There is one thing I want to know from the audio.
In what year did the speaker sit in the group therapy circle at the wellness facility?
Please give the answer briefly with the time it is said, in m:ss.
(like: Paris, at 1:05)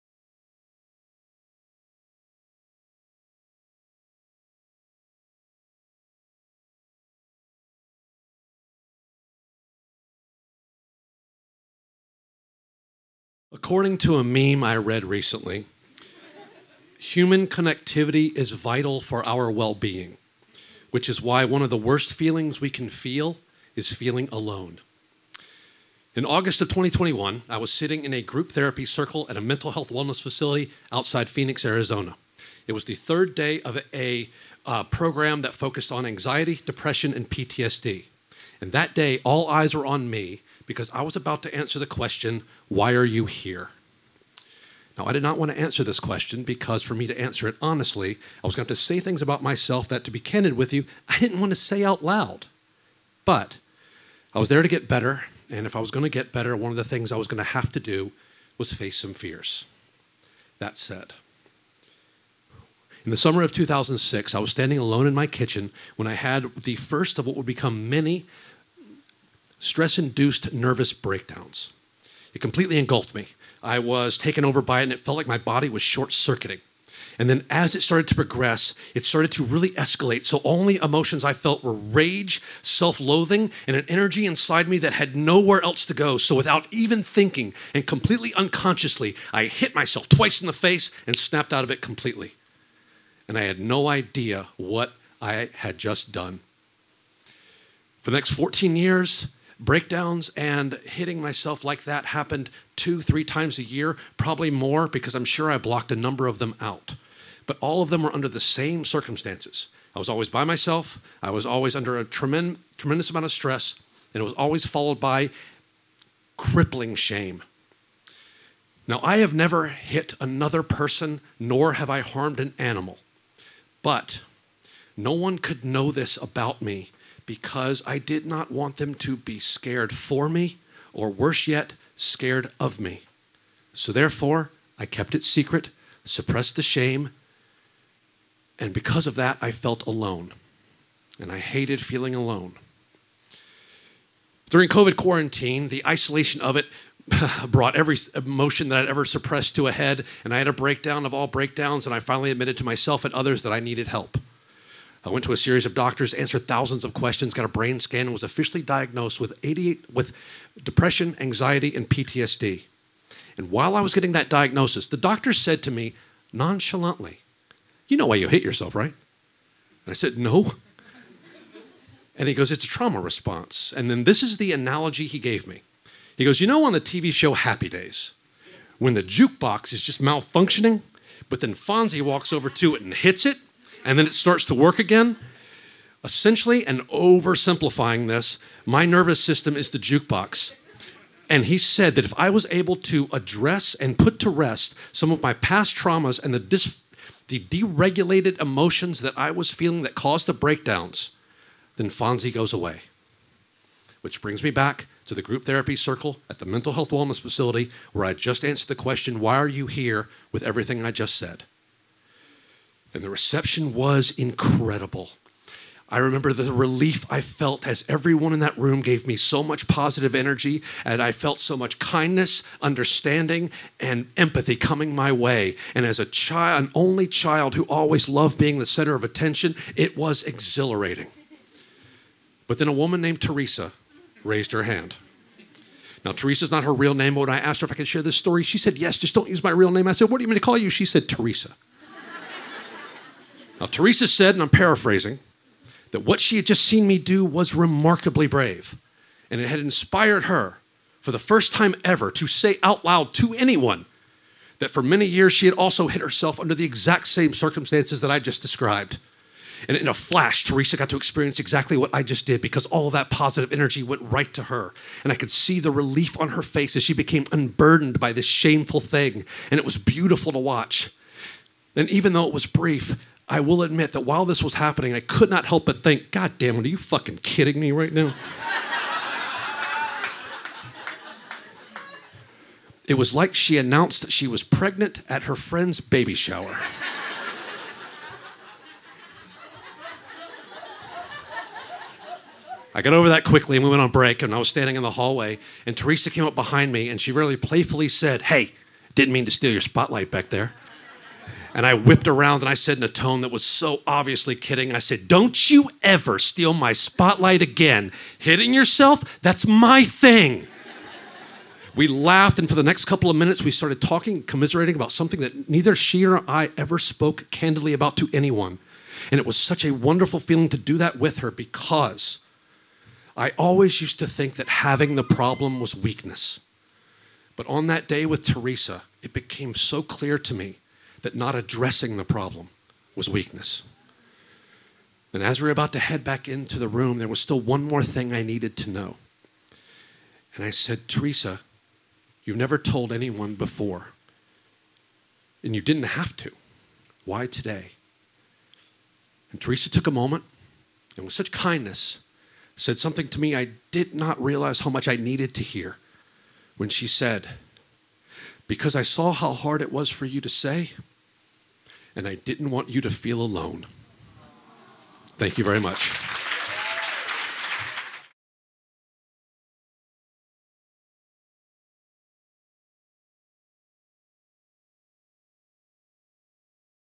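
2021, at 0:26.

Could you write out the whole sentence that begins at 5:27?
But on that day with Theresa, it became so clear to me that not addressing the problem was weakness.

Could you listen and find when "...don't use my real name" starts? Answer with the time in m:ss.
3:59.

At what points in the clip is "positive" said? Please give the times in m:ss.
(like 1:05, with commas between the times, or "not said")
3:39, 4:23.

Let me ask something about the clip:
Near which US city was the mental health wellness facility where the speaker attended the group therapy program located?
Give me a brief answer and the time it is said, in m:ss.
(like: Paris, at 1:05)
Phoenix, at 0:31.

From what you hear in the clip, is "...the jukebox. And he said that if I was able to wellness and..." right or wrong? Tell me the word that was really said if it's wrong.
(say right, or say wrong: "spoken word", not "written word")
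wrong: "address", not "wellness".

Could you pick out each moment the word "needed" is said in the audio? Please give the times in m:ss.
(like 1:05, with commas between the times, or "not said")
2:33, 5:38, 5:54.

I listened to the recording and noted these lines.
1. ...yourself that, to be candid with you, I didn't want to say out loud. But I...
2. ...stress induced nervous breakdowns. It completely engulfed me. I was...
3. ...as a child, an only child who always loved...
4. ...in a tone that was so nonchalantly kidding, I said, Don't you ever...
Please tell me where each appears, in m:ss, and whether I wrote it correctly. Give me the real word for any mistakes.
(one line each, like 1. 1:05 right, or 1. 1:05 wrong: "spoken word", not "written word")
1. 0:49 wrong: "myself", not "yourself"
2. 1:09 right
3. 3:45 right
4. 5:02 wrong: "obviously", not "nonchalantly".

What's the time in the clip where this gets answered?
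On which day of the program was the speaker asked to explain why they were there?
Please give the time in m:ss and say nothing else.
0:32.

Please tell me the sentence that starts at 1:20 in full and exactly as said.
So only emotions I felt were rage, self loathing, and an energy inside me that had nowhere else to go.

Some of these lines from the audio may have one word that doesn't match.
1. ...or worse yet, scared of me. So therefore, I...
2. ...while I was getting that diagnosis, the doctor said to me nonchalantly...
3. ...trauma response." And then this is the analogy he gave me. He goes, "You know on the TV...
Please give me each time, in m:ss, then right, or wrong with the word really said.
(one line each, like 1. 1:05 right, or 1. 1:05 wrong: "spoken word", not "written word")
1. 2:10 right
2. 2:43 right
3. 2:52 right.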